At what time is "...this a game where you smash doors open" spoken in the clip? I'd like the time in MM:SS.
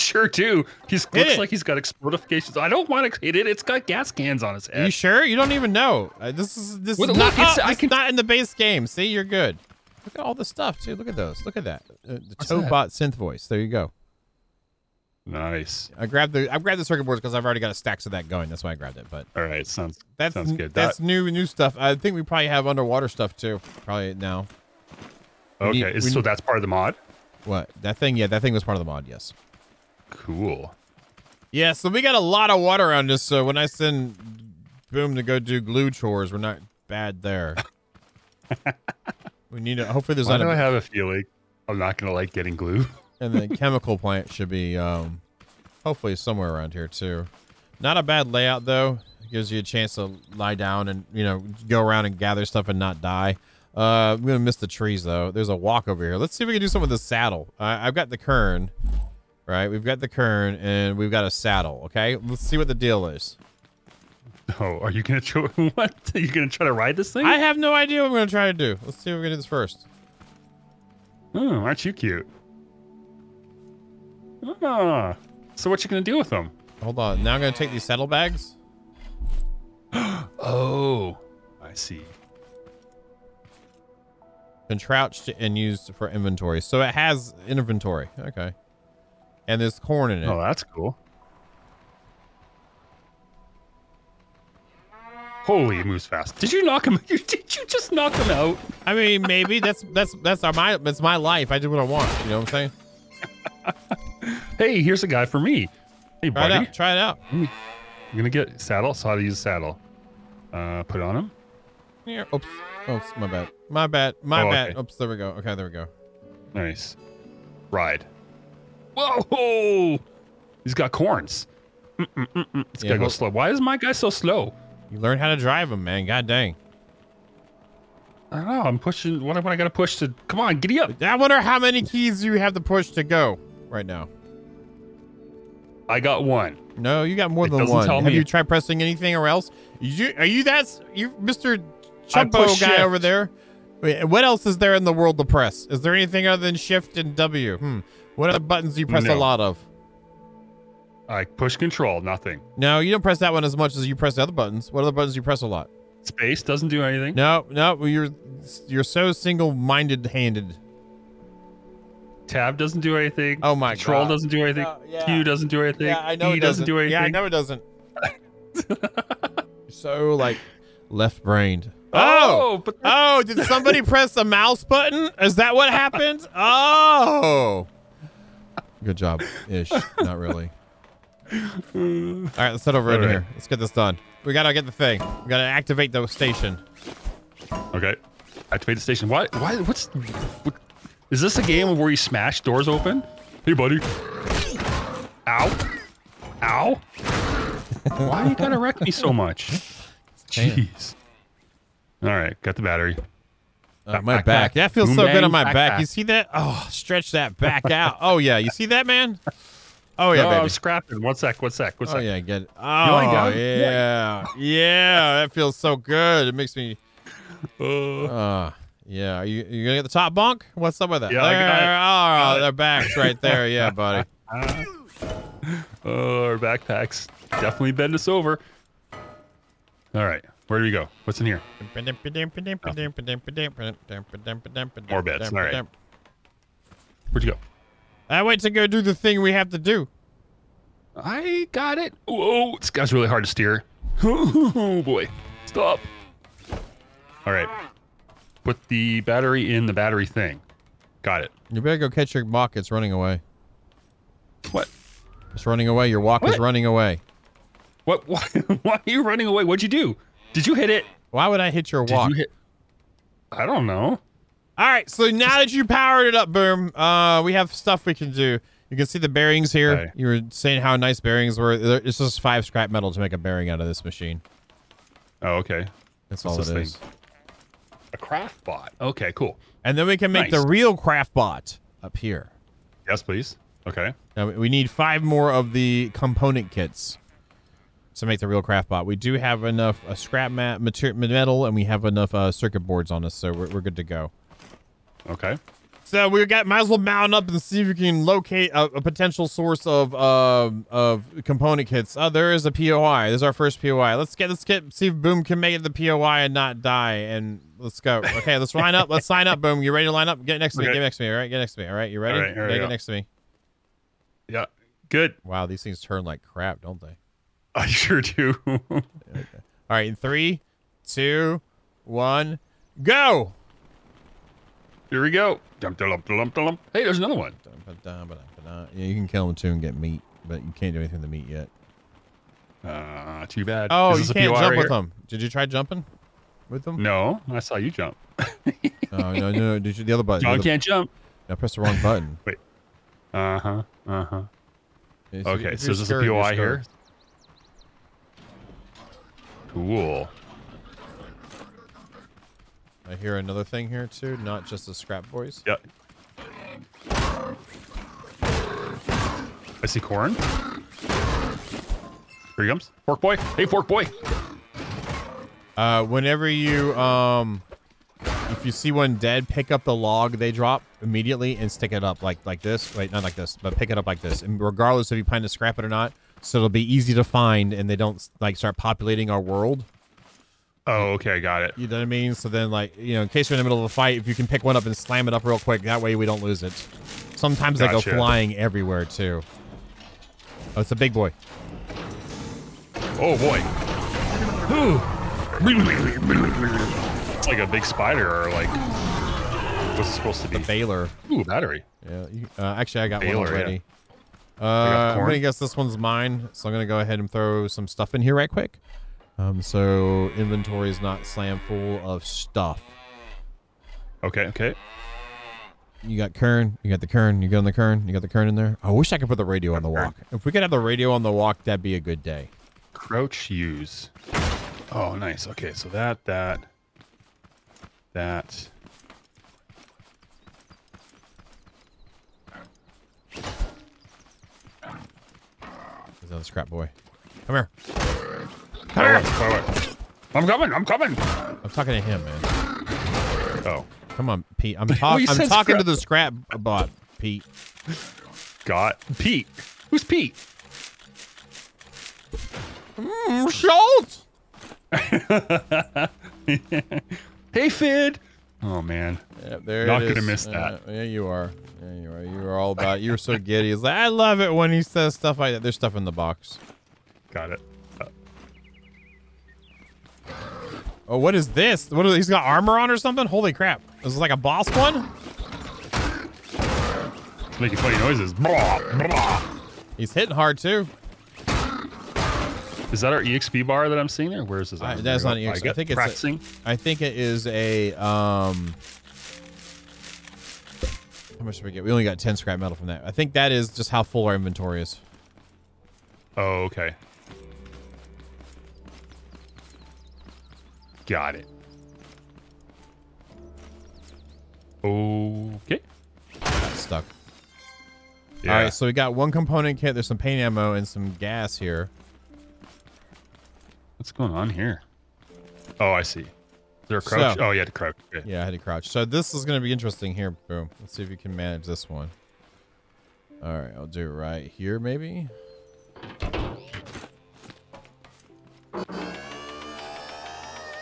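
03:11.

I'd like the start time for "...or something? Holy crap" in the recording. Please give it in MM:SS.
07:52.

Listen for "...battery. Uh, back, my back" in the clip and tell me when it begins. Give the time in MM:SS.
03:22.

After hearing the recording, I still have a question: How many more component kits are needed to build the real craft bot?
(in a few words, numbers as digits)
5.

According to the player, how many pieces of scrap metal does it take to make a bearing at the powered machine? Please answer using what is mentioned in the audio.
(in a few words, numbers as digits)
5.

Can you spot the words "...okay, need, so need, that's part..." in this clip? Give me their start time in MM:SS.
00:25.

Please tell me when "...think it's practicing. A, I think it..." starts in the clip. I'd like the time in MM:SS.
08:05.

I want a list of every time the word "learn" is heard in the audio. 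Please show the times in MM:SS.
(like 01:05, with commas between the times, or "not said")
02:04.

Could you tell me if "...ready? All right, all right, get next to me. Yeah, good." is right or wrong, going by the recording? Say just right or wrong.
right.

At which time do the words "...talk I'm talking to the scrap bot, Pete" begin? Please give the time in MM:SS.
07:24.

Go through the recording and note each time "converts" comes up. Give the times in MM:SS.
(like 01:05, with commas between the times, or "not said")
not said.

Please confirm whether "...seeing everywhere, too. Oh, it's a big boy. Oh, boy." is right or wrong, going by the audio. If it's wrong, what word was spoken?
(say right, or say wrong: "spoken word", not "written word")
wrong: "flying", not "seeing".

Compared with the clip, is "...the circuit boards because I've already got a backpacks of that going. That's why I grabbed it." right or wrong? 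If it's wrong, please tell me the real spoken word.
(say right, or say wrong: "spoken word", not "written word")
wrong: "stacks", not "backpacks".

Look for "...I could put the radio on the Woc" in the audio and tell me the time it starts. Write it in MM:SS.
06:58.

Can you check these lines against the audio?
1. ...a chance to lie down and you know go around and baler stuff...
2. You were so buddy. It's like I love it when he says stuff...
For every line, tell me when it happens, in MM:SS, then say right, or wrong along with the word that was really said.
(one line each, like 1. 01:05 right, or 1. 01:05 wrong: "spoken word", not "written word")
1. 00:49 wrong: "gather", not "baler"
2. 07:42 wrong: "giddy", not "buddy".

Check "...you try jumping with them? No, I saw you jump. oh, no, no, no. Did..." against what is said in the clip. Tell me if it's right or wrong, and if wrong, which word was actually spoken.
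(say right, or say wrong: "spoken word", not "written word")
right.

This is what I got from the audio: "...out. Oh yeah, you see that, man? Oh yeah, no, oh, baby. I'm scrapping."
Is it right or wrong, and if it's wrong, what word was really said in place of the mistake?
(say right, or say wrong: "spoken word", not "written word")
right.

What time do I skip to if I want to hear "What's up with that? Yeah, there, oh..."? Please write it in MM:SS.
03:40.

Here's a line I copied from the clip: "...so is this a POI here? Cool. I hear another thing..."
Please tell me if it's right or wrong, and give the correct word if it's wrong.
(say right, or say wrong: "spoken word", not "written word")
right.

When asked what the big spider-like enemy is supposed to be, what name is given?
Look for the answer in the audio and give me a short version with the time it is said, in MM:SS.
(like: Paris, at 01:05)
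A baler, at 06:40.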